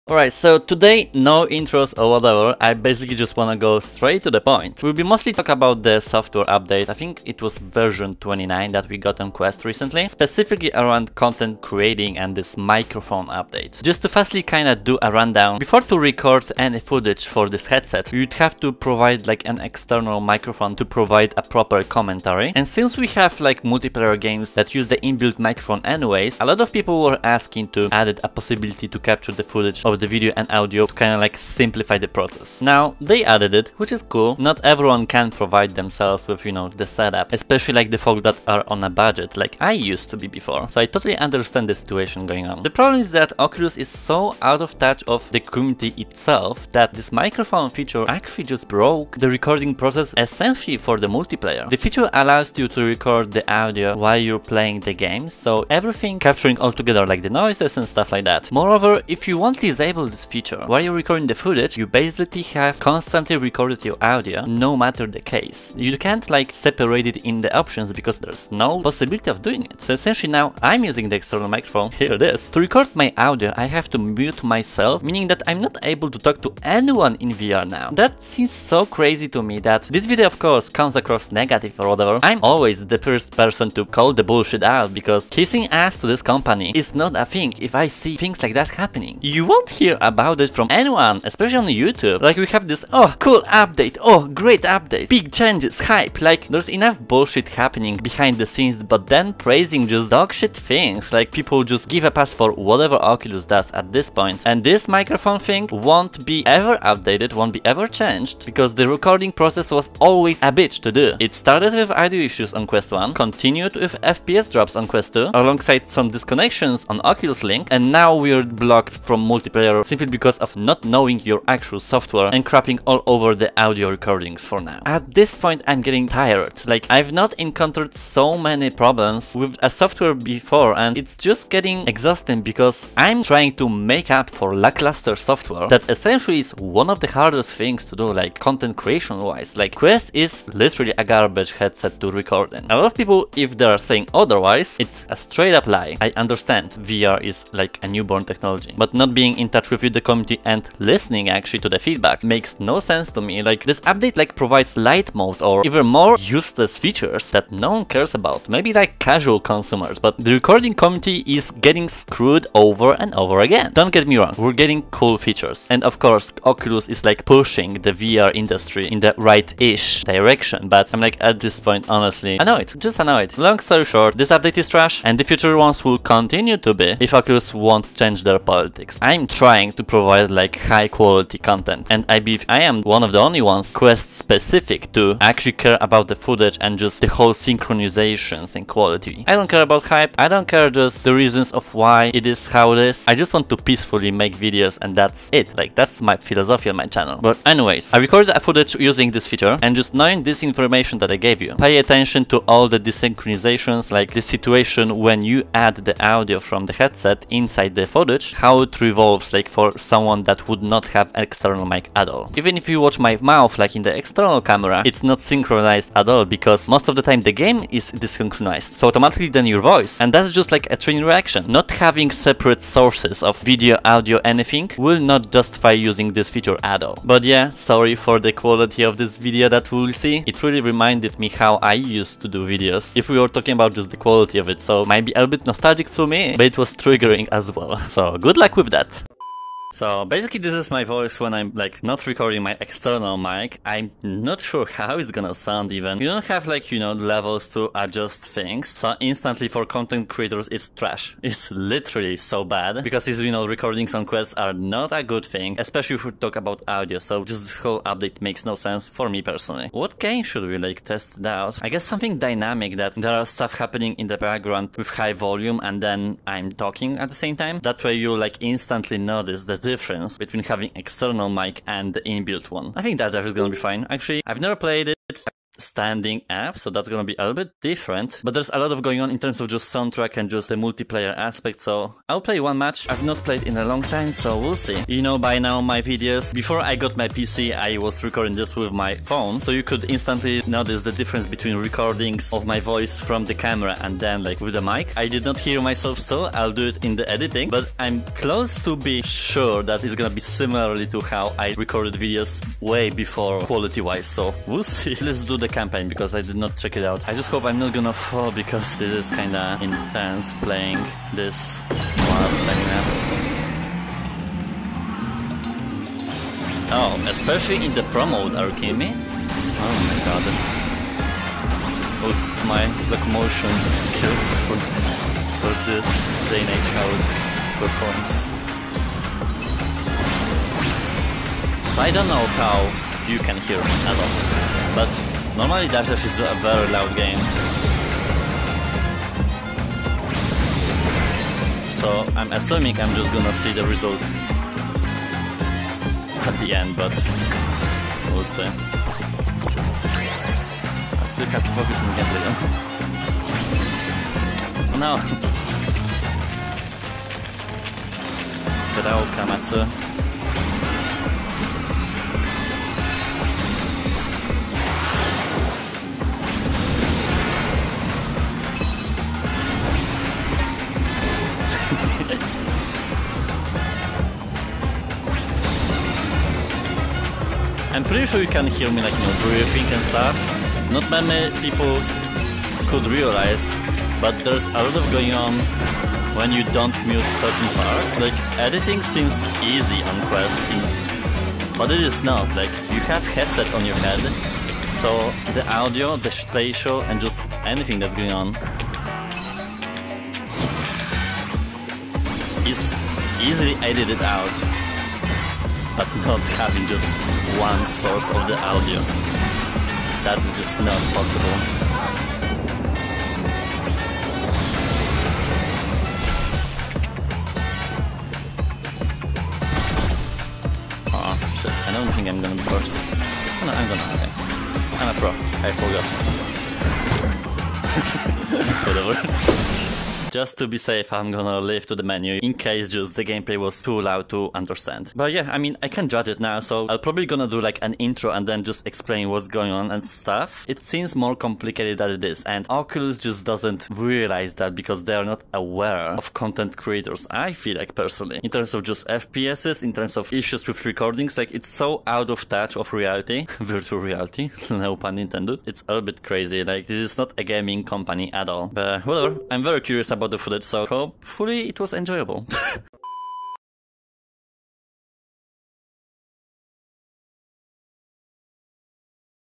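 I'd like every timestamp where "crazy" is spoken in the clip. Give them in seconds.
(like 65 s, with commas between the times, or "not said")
78 s, 456 s.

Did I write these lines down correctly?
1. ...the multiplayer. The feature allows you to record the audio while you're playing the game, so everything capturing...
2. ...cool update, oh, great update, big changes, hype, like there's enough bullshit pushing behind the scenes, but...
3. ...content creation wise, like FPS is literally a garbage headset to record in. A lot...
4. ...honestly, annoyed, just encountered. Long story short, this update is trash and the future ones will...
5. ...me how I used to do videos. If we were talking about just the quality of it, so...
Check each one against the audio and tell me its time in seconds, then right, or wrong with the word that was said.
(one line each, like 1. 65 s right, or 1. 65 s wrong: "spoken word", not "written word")
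1. 50 s right
2. 93 s wrong: "happening", not "pushing"
3. 138 s wrong: "Quest", not "FPS"
4. 171 s wrong: "annoyed", not "encountered"
5. 231 s right.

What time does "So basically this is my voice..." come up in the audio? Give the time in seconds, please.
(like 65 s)
239 s.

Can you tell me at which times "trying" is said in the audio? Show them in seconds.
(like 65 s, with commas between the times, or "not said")
133 s, 179 s.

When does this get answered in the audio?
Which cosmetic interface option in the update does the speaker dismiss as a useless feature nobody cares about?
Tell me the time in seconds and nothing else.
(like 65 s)
154 s.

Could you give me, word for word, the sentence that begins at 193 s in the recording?
I just want to peacefully make videos and that's it.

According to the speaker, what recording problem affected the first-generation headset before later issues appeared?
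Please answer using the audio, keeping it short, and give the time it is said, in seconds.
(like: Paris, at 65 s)
audio issues, at 111 s.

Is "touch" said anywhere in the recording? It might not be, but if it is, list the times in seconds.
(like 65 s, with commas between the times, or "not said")
44 s, 149 s, 452 s.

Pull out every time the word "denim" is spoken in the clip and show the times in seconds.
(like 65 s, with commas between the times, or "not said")
not said.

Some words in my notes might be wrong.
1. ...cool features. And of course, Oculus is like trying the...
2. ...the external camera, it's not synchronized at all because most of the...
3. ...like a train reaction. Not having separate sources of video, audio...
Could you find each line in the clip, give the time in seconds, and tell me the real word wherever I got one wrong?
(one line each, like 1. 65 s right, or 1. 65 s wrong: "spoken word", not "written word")
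1. 164 s wrong: "pushing", not "trying"
2. 213 s right
3. 220 s right.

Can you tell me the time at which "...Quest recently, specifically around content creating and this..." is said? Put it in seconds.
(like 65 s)
9 s.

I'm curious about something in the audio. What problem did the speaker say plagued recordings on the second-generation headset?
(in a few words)
FPS drops.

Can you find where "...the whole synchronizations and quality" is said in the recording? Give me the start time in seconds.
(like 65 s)
187 s.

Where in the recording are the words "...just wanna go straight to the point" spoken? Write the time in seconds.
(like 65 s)
3 s.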